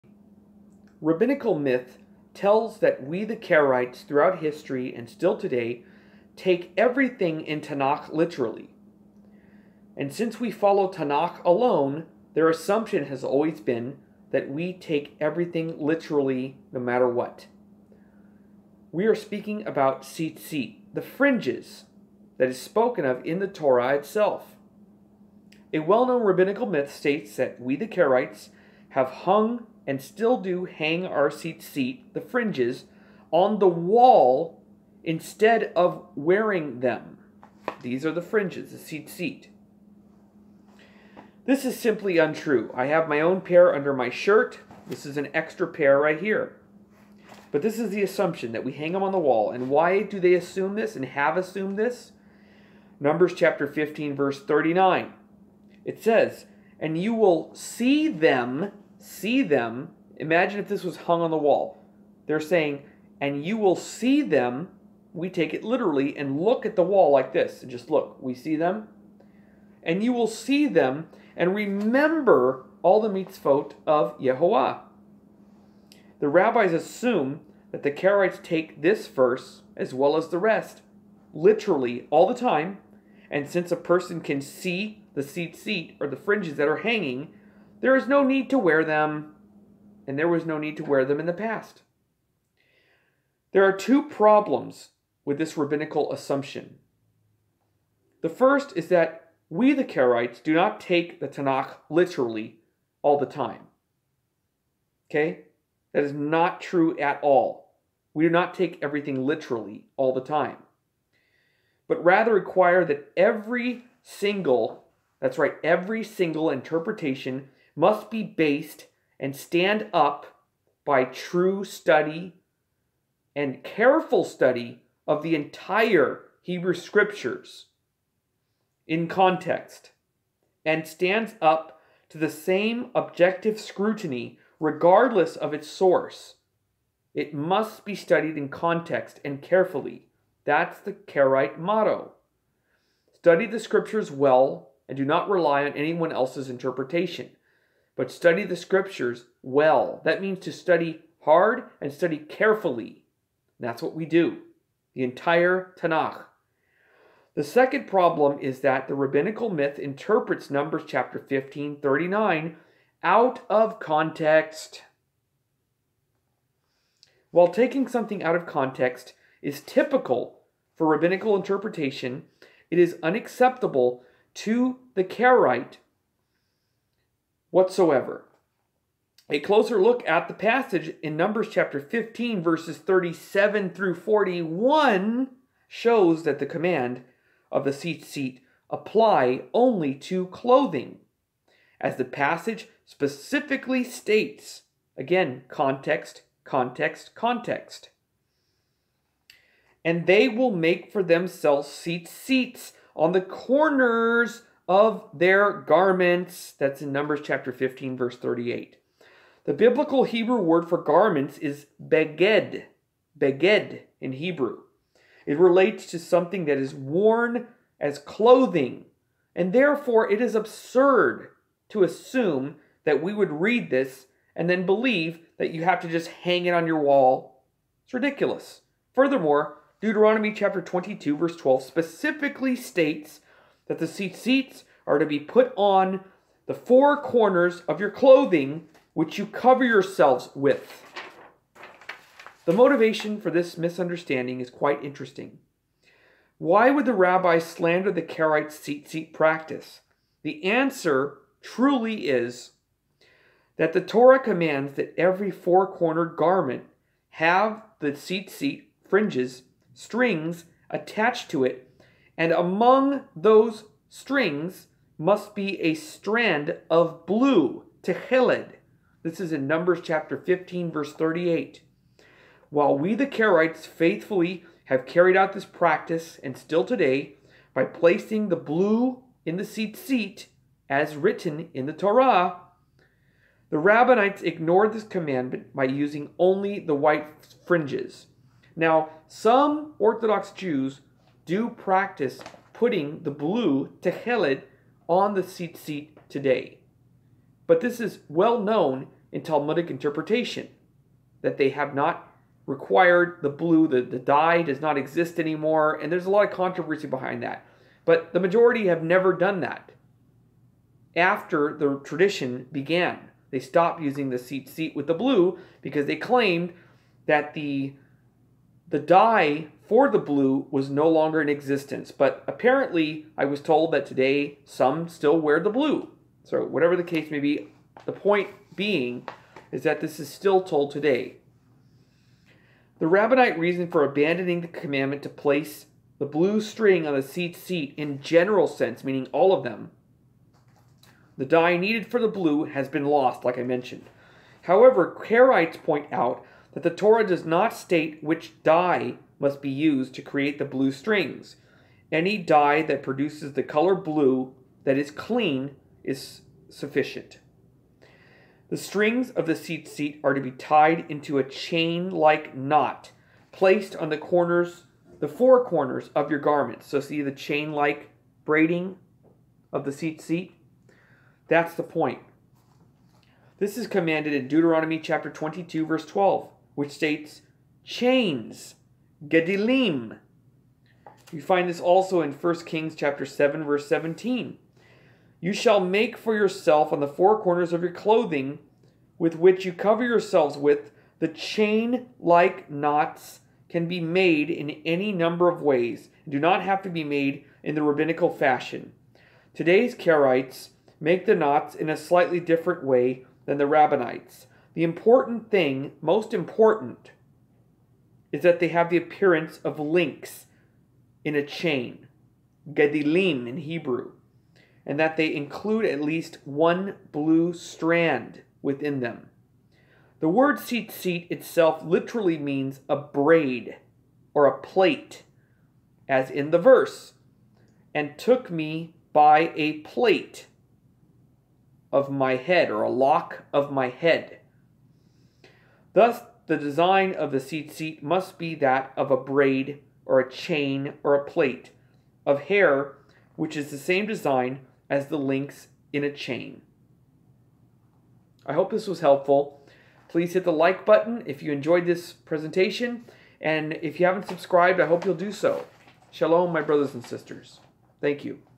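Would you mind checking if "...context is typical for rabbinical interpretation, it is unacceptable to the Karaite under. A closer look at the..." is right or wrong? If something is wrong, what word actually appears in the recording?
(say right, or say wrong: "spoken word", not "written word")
wrong: "whatsoever", not "under".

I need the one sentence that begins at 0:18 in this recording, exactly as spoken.
We are speaking about tzitzit, the fringes that is spoken of in the Torah itself.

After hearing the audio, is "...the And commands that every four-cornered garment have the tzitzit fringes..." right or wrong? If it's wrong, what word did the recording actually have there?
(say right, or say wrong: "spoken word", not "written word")
wrong: "Torah", not "And".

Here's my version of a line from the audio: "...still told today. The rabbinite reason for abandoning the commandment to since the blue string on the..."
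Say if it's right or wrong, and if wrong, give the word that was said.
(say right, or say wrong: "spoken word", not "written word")
wrong: "place", not "since".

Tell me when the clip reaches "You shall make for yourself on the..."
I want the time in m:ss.
6:25.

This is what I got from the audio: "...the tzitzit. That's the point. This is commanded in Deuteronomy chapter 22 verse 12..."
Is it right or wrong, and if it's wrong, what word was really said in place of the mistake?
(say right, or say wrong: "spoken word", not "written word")
right.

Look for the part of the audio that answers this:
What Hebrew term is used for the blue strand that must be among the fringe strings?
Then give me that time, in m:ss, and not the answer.
4:27.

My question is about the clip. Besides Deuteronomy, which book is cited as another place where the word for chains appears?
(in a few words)
1 Kings.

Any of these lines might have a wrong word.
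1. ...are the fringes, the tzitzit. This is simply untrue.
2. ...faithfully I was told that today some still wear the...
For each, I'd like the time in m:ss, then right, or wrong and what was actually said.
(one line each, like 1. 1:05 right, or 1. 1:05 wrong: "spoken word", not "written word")
1. 0:38 right
2. 5:22 wrong: "apparently", not "faithfully".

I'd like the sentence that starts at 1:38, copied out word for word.
The first is that we, the Karaites, do not take the Tanakh literally all the time.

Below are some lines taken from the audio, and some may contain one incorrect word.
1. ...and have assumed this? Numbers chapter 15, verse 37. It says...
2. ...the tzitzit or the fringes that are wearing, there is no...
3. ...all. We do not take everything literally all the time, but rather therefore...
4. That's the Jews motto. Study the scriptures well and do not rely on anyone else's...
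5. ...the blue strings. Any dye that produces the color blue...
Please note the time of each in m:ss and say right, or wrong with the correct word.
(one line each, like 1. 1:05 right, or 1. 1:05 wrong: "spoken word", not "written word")
1. 0:50 wrong: "39", not "37"
2. 1:25 wrong: "hanging", not "wearing"
3. 1:47 wrong: "require", not "therefore"
4. 2:20 wrong: "Karaite", not "Jews"
5. 5:50 right.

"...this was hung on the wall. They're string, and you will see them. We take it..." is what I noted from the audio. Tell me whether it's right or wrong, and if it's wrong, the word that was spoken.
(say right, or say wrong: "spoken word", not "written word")
wrong: "saying", not "string".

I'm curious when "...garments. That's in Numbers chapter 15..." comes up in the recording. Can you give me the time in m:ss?
3:25.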